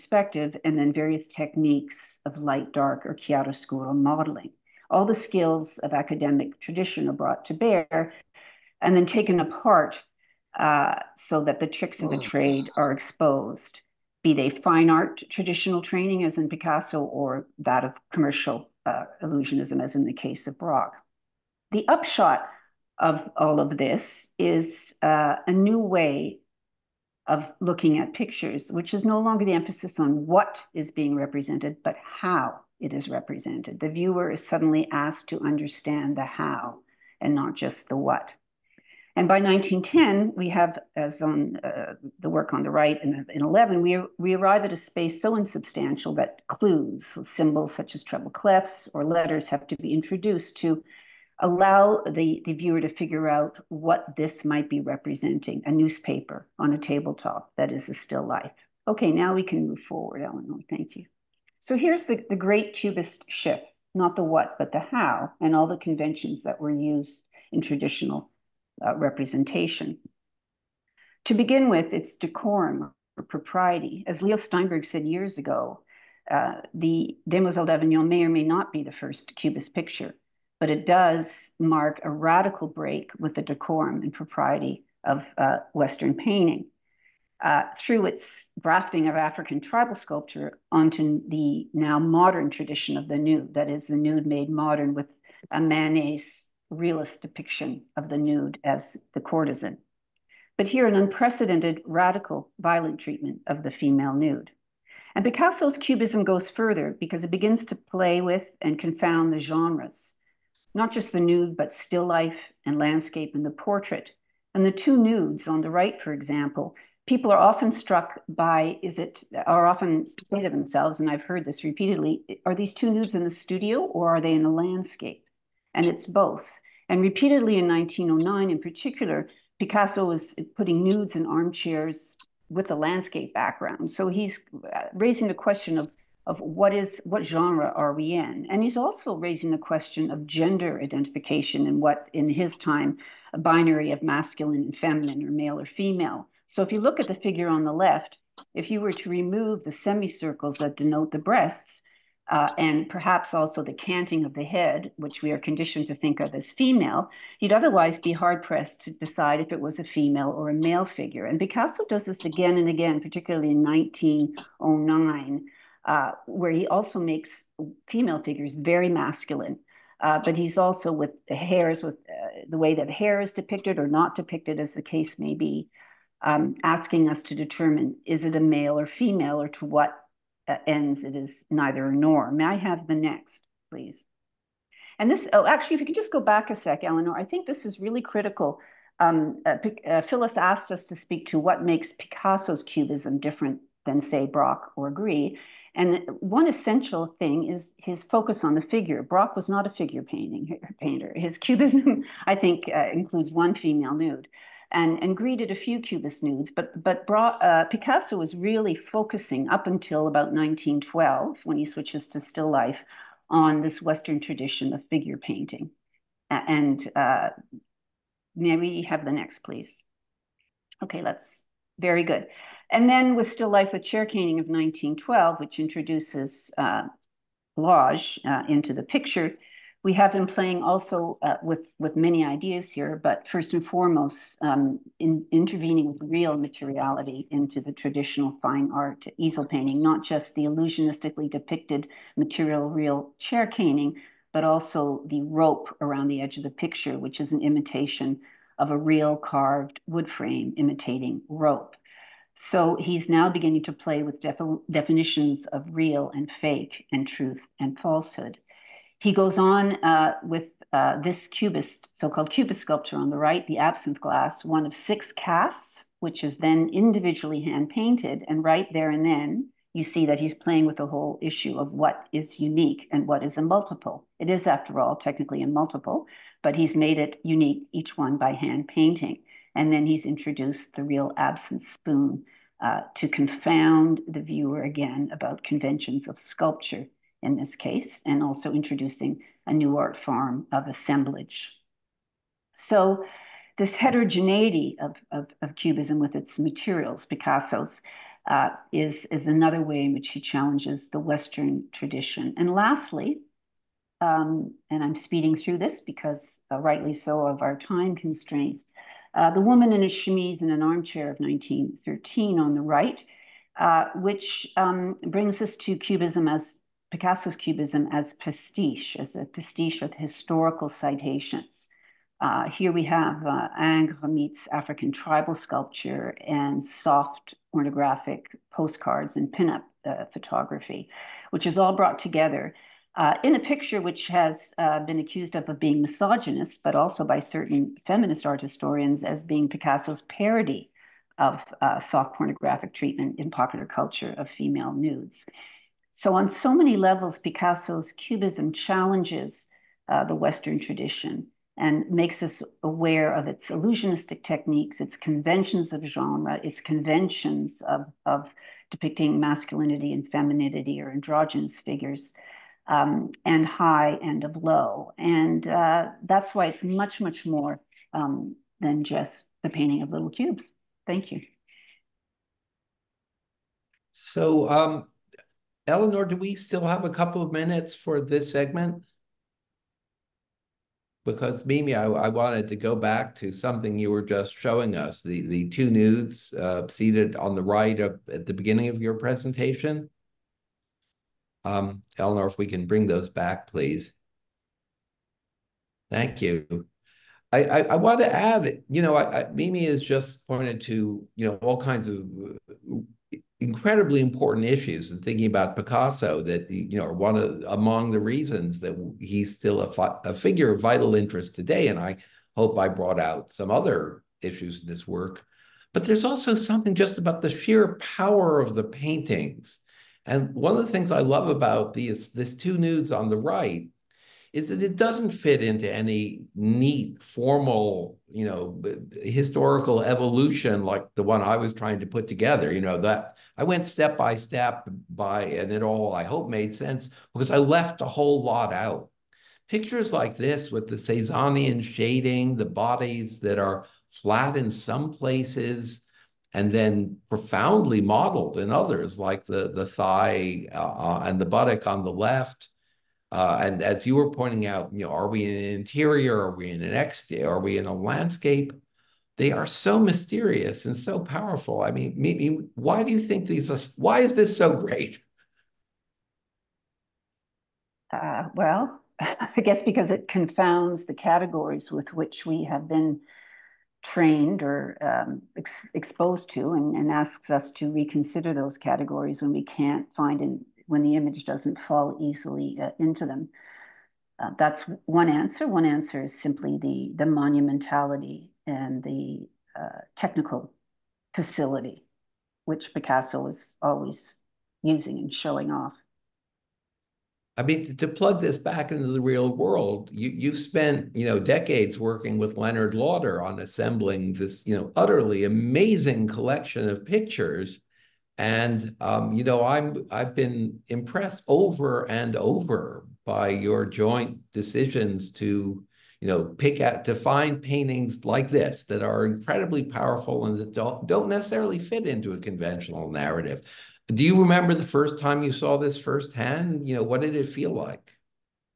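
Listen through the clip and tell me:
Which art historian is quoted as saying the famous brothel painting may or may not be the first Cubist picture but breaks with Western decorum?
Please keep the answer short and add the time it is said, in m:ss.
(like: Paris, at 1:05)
Leo Steinberg, at 1:14.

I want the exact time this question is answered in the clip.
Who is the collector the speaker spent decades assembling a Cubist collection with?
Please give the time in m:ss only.
8:22.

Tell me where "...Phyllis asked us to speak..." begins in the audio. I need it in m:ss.
3:10.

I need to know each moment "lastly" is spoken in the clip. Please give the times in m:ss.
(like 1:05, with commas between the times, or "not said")
5:02.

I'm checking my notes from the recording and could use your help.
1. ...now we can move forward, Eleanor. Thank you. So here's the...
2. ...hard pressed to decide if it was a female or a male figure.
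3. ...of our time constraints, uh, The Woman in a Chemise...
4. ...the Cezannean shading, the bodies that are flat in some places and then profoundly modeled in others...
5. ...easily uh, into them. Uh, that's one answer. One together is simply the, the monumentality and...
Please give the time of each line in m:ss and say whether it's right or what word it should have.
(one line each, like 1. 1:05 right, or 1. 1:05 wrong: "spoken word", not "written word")
1. 0:59 right
2. 2:38 right
3. 5:07 right
4. 7:20 right
5. 8:01 wrong: "answer", not "together".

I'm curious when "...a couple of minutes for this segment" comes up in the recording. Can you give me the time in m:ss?
6:16.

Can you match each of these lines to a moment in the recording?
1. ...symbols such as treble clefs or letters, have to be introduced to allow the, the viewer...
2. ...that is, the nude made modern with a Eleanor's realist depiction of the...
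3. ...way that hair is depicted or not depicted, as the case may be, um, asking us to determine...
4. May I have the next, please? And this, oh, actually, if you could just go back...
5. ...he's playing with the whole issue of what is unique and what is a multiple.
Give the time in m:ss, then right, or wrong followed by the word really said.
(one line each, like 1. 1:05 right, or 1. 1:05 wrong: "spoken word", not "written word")
1. 0:47 right
2. 1:33 wrong: "Manet", not "Eleanor"
3. 2:52 right
4. 3:02 right
5. 4:30 right.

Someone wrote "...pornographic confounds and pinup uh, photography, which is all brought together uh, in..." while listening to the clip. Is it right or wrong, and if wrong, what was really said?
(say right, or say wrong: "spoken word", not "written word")
wrong: "postcards", not "confounds".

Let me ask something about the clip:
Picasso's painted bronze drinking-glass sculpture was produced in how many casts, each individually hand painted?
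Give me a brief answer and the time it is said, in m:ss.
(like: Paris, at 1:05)
6, at 4:24.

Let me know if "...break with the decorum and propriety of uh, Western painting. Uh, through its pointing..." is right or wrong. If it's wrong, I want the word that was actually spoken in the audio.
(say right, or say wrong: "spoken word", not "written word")
wrong: "grafting", not "pointing".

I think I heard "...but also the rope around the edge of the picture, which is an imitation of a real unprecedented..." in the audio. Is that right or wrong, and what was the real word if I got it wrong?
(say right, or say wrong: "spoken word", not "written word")
wrong: "carved", not "unprecedented".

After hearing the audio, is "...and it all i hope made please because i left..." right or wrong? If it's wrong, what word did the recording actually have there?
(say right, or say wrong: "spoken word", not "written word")
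wrong: "sense", not "please".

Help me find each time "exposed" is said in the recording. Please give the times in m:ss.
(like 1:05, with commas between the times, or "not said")
0:12, 7:55.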